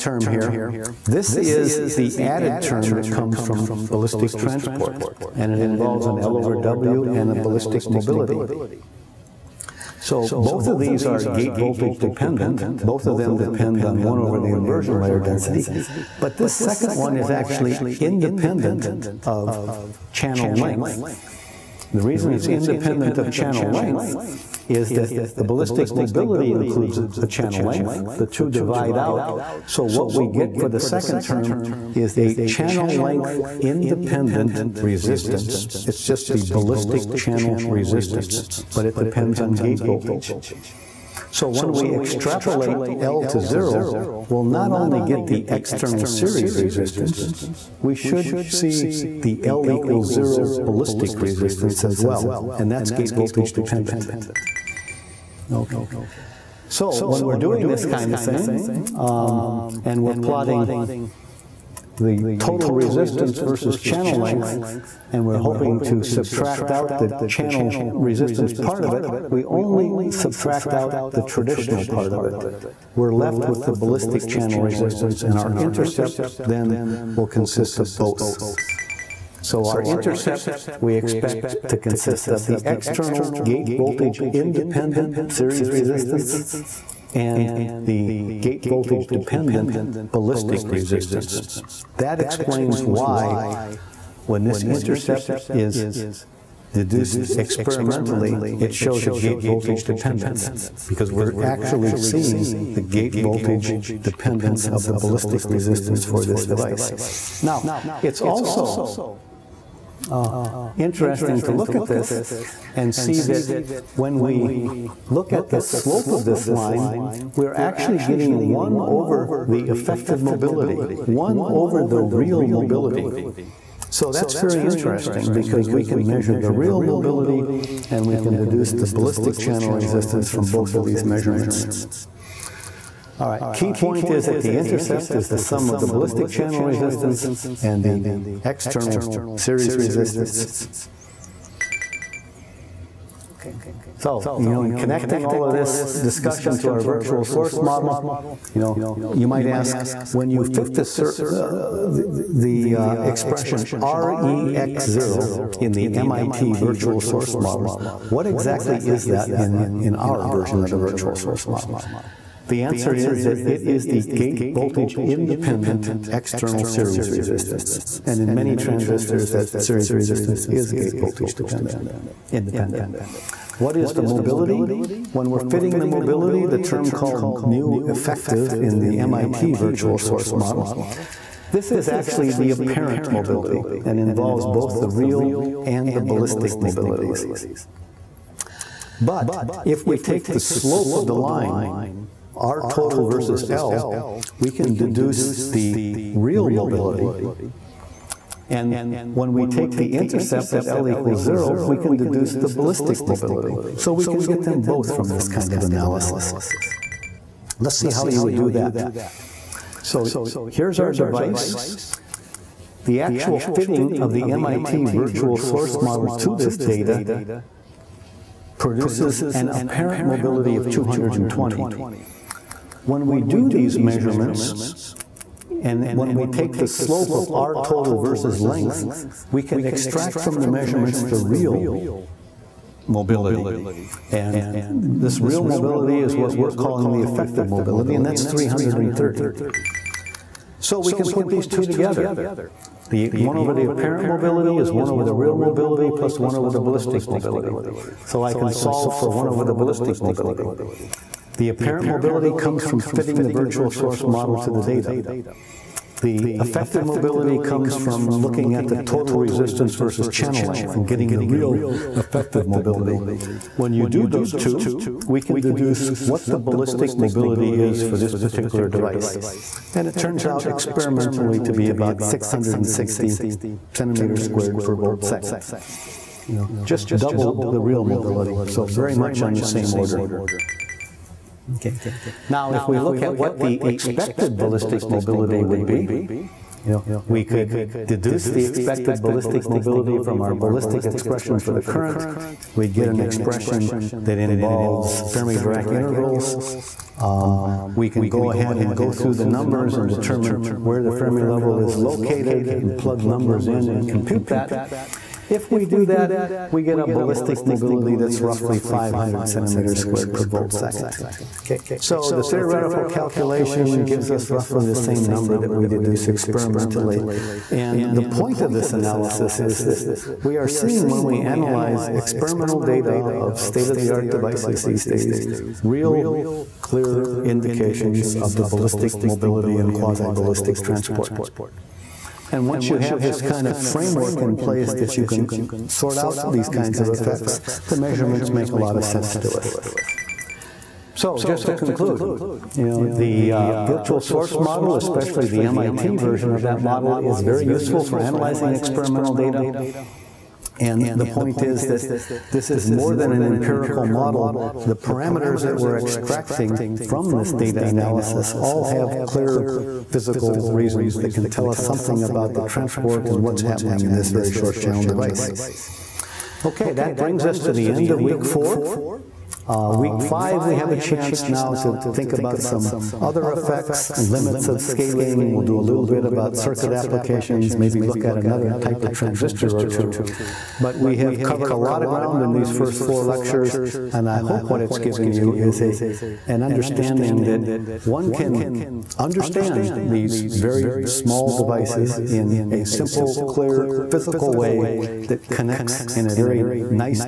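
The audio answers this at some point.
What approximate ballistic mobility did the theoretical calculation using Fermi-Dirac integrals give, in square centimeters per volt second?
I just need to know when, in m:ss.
5:08.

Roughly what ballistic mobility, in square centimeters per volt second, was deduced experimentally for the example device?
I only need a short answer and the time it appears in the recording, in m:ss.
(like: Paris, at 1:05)
660, at 4:32.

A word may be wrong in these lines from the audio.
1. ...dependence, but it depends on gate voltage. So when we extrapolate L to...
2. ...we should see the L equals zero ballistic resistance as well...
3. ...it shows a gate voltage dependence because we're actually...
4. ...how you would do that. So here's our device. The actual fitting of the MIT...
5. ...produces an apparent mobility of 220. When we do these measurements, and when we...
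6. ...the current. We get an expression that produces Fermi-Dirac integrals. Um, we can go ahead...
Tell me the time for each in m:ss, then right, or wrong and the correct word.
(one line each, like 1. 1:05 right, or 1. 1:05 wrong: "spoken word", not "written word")
1. 0:37 wrong: "resistance", not "dependence"
2. 0:47 right
3. 1:38 right
4. 3:27 right
5. 3:38 right
6. 4:51 wrong: "involves", not "produces".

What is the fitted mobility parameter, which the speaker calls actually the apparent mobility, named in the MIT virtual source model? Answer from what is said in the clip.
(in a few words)
mu effective.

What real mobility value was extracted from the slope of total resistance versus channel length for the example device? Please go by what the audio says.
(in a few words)
330.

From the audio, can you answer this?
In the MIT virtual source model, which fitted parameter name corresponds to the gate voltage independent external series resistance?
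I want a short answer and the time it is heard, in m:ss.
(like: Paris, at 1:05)
REX0, at 2:33.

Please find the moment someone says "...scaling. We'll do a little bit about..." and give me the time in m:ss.
6:14.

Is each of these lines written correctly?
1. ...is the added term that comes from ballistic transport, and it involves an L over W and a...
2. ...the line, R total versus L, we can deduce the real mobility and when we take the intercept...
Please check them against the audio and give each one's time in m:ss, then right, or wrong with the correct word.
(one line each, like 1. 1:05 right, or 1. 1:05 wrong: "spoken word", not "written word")
1. 0:01 right
2. 3:11 right.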